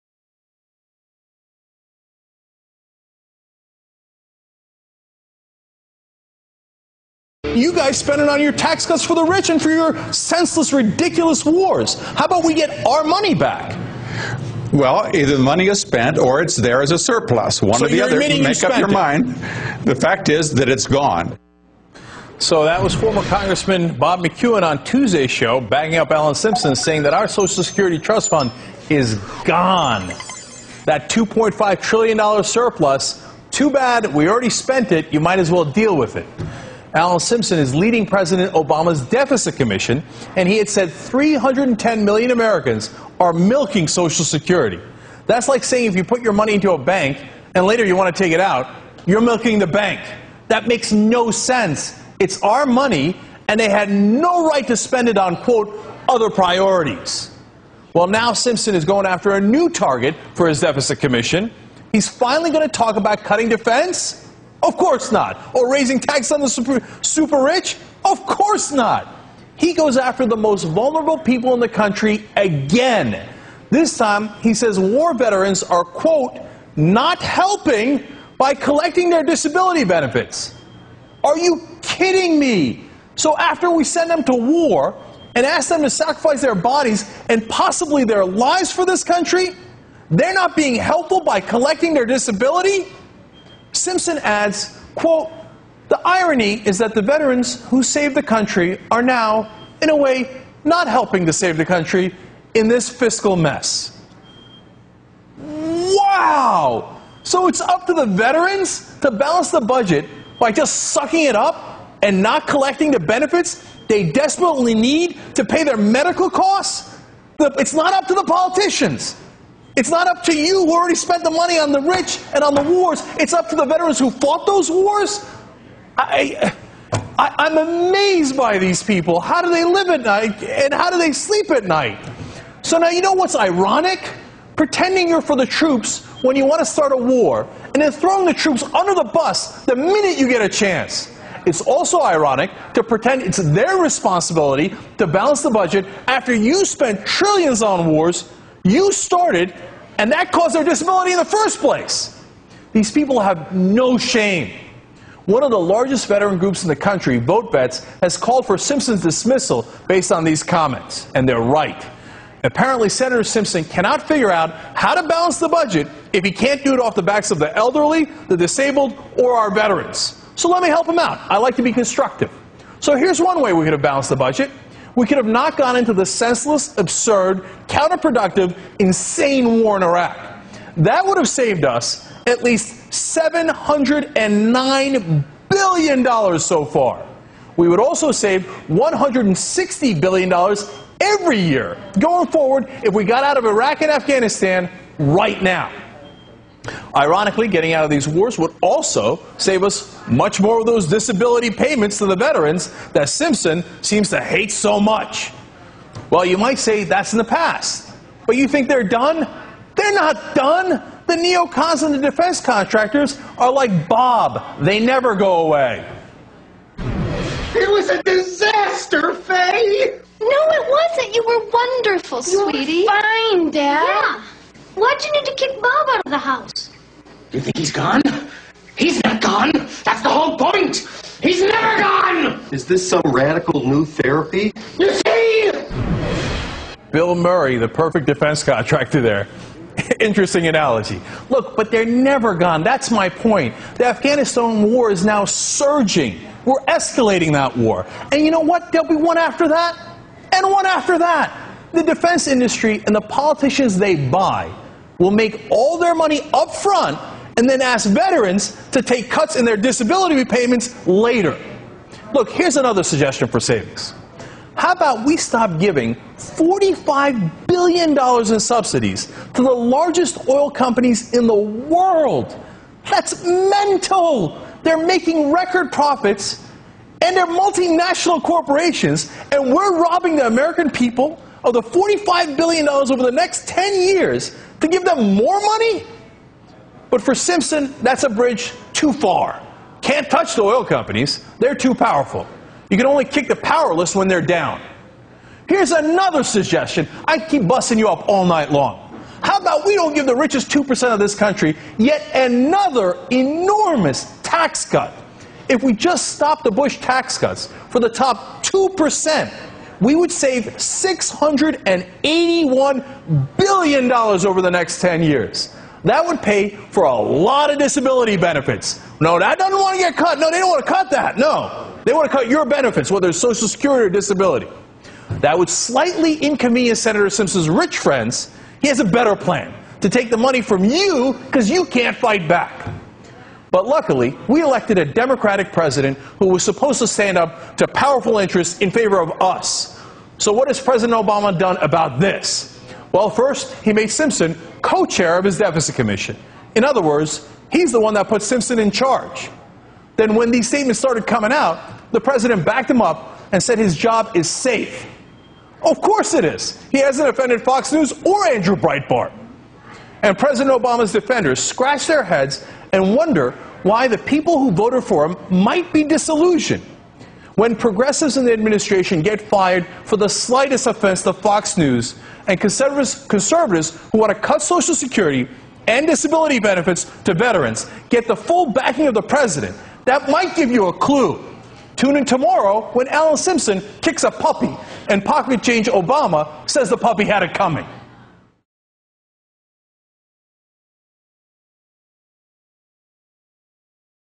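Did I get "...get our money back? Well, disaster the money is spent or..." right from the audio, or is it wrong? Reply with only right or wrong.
wrong.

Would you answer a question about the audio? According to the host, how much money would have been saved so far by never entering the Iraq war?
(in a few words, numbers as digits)
$709 billion.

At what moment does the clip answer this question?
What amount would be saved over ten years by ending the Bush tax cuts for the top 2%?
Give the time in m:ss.
5:10.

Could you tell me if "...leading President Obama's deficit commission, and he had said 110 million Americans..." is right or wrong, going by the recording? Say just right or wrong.
wrong.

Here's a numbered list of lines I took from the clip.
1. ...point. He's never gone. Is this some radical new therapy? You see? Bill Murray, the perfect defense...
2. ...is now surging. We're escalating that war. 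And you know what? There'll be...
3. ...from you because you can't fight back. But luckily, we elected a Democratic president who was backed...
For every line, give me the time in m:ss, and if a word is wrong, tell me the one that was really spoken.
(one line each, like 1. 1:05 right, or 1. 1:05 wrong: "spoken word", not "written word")
1. 3:50 right
2. 4:04 right
3. 5:30 wrong: "supposed", not "backed".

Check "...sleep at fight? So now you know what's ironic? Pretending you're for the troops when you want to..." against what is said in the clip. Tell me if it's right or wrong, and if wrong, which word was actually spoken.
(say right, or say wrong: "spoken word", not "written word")
wrong: "night", not "fight".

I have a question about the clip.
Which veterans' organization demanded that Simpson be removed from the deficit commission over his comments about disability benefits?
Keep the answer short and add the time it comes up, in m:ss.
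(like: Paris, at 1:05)
VoteVets, at 2:37.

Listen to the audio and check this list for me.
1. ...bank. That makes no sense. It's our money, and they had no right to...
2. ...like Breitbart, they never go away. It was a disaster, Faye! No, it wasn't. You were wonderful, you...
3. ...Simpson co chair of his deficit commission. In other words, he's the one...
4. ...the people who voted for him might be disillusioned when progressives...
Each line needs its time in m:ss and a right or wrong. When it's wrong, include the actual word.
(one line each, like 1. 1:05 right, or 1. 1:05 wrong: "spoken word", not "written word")
1. 0:49 right
2. 3:33 wrong: "Bob", not "Breitbart"
3. 5:43 right
4. 6:03 right.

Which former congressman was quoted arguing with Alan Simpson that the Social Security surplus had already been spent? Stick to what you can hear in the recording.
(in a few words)
Bob McEwen.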